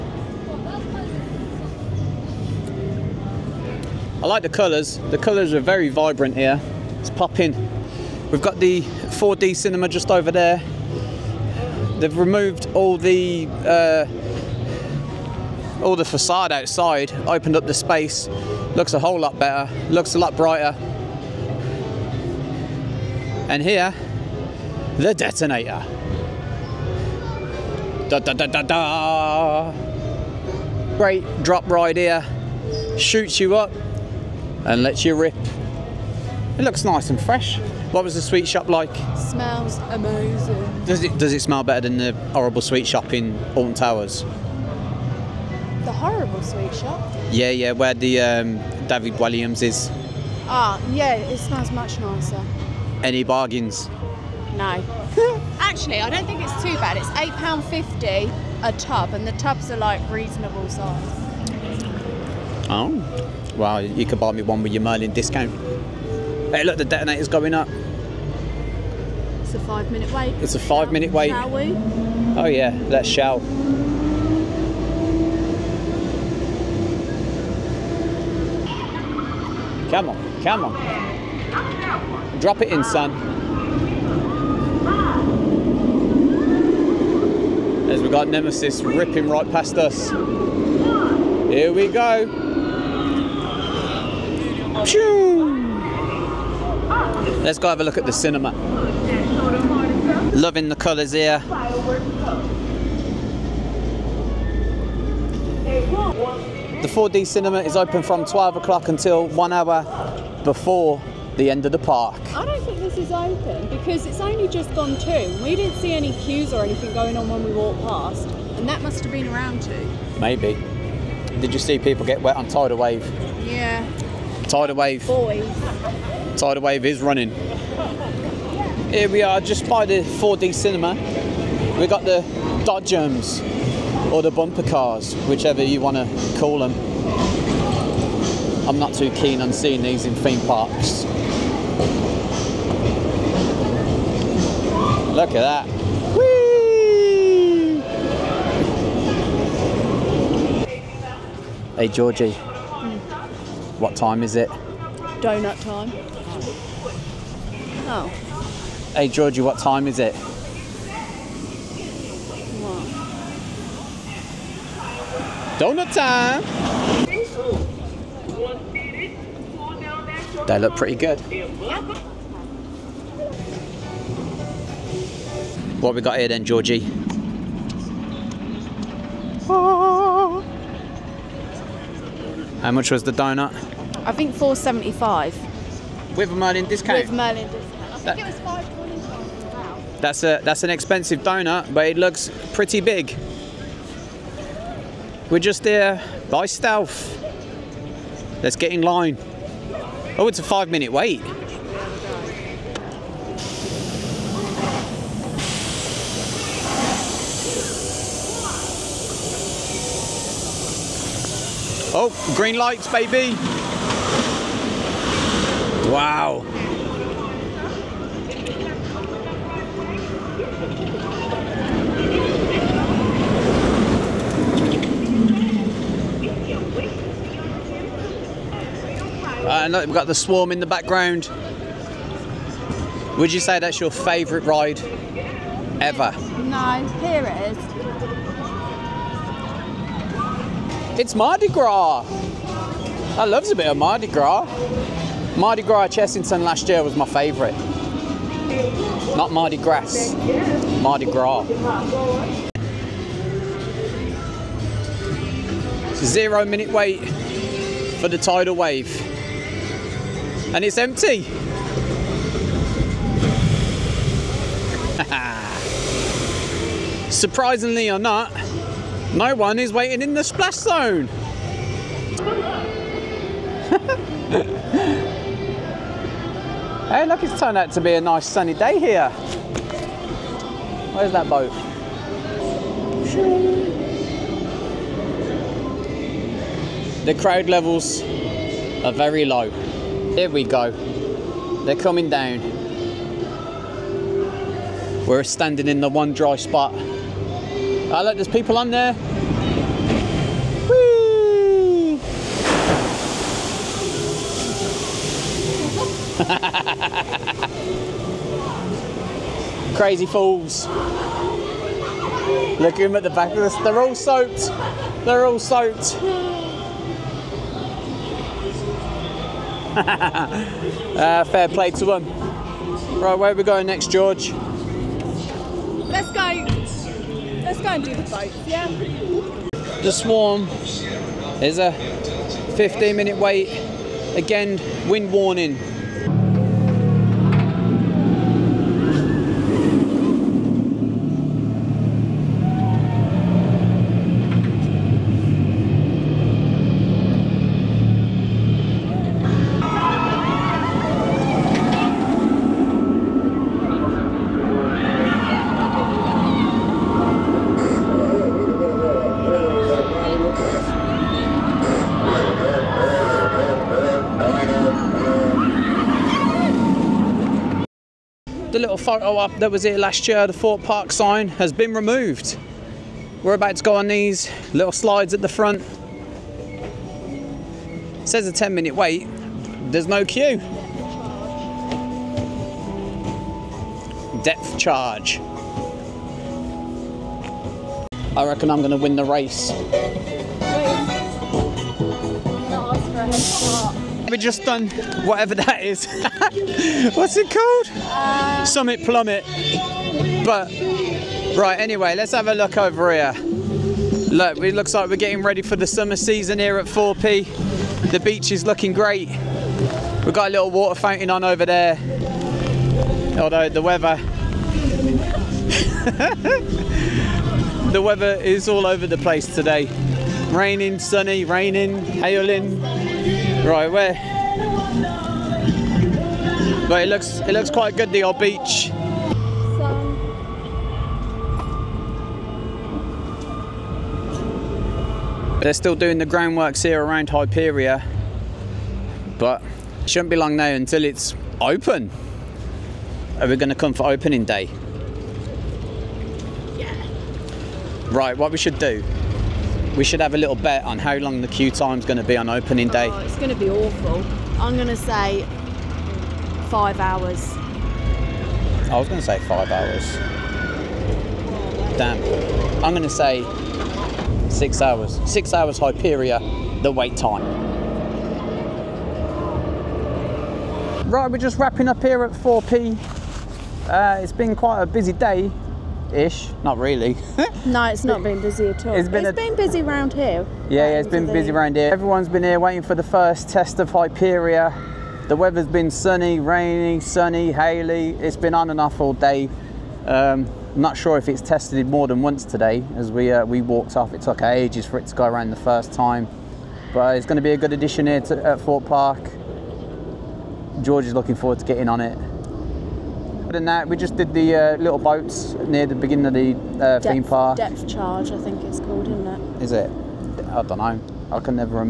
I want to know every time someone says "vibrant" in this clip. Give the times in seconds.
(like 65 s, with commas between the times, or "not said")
5 s.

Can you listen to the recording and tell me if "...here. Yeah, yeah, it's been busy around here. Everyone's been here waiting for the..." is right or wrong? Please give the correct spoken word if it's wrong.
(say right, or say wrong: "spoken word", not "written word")
right.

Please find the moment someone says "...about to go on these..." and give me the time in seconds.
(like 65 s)
373 s.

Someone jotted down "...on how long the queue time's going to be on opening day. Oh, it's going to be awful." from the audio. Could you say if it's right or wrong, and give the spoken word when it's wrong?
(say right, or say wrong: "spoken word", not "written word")
right.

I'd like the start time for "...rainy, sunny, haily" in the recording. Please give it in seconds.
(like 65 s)
486 s.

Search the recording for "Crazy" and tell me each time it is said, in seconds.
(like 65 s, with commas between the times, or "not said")
309 s.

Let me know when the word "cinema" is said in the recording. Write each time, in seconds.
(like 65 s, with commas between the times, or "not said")
9 s, 98 s, 107 s, 130 s.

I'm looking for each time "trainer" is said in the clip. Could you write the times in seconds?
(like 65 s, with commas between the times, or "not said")
not said.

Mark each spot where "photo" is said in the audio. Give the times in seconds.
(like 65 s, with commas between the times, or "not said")
368 s.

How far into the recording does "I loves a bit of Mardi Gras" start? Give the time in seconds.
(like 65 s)
243 s.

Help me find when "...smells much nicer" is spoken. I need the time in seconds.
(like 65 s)
51 s.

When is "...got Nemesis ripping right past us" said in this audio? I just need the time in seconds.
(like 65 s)
88 s.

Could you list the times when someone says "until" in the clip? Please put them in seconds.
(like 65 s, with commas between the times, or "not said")
108 s, 440 s.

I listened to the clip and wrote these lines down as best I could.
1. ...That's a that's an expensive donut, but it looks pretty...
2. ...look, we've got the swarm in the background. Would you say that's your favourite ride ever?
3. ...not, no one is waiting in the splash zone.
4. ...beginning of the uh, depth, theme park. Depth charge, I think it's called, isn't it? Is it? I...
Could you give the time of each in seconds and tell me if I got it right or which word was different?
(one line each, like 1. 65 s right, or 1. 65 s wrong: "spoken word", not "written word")
1. 190 s right
2. 229 s right
3. 268 s right
4. 505 s right.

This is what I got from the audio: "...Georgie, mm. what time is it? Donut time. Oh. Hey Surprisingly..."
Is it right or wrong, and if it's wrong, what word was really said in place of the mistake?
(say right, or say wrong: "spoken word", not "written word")
wrong: "Georgie", not "Surprisingly".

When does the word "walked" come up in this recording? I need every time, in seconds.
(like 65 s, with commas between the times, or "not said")
117 s, 493 s.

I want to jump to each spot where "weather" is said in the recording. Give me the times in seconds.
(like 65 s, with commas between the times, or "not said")
413 s, 417 s, 485 s.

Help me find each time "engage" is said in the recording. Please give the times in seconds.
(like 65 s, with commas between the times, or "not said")
not said.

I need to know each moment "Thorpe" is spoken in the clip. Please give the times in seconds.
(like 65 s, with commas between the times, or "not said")
370 s, 406 s, 472 s, 498 s.